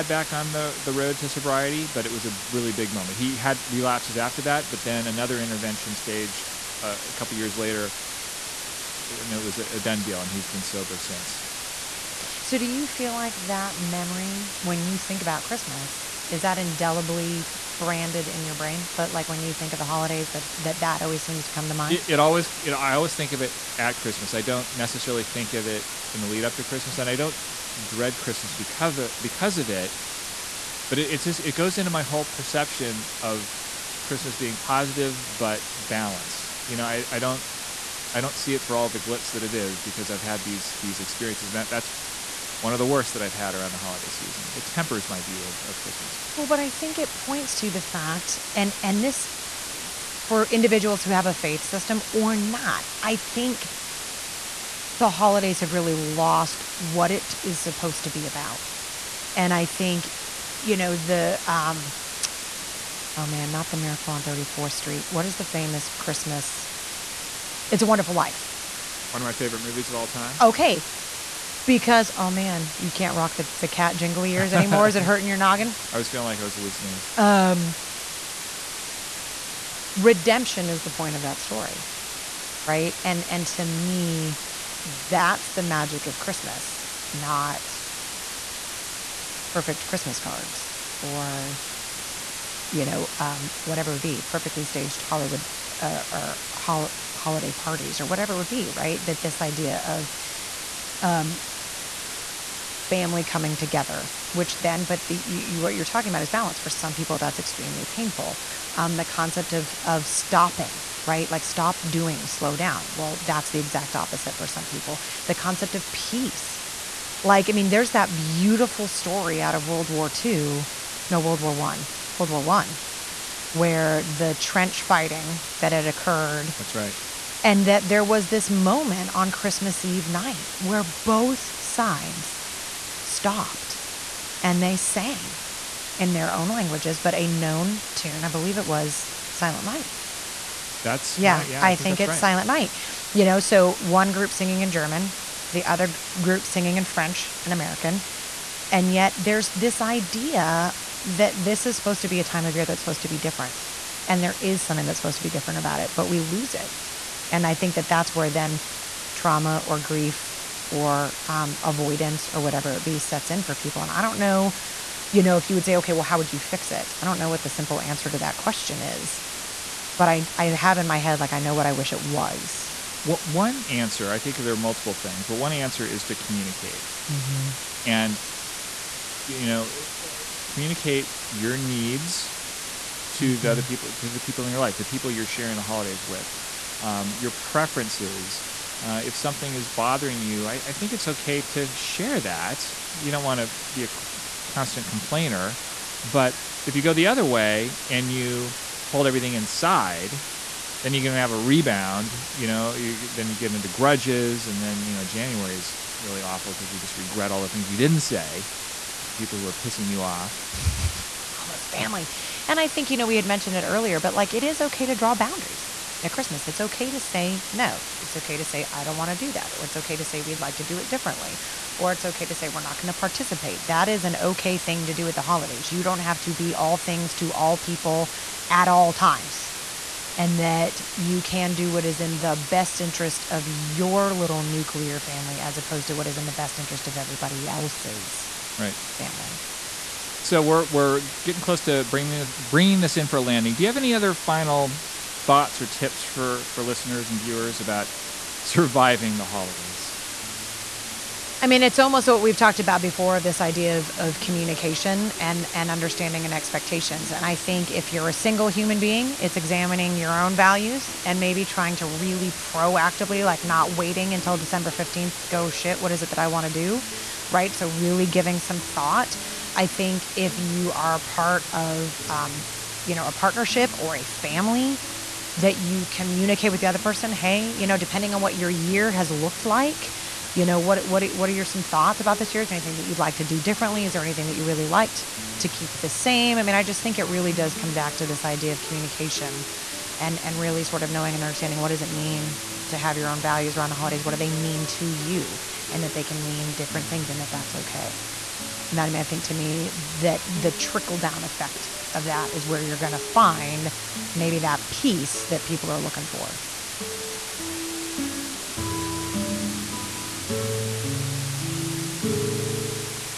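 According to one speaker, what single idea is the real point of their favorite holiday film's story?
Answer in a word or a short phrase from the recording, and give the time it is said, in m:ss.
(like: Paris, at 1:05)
Redemption, at 1:19.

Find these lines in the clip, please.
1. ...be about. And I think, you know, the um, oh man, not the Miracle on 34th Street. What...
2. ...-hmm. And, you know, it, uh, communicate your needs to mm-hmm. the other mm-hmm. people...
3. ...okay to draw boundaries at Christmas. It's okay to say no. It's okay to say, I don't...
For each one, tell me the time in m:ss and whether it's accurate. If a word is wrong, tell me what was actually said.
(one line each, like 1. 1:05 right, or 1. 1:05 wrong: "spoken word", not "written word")
1. 0:58 right
2. 2:57 right
3. 3:34 right.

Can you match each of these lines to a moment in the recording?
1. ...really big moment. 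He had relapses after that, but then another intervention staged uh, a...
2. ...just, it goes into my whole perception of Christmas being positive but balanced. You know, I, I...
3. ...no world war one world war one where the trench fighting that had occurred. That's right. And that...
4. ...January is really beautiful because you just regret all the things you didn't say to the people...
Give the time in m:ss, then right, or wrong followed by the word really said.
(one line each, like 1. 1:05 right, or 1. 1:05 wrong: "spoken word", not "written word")
1. 0:02 right
2. 0:31 right
3. 2:00 right
4. 3:25 wrong: "awful", not "beautiful".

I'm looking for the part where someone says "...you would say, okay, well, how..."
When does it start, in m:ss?
2:45.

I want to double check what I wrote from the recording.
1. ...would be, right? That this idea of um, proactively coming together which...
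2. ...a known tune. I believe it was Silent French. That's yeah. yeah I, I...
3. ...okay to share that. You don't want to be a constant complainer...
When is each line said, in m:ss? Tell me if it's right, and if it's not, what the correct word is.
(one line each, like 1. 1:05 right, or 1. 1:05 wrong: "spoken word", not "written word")
1. 1:38 wrong: "family", not "proactively"
2. 2:17 wrong: "Night", not "French"
3. 3:11 right.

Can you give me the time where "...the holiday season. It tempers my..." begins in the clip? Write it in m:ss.
0:43.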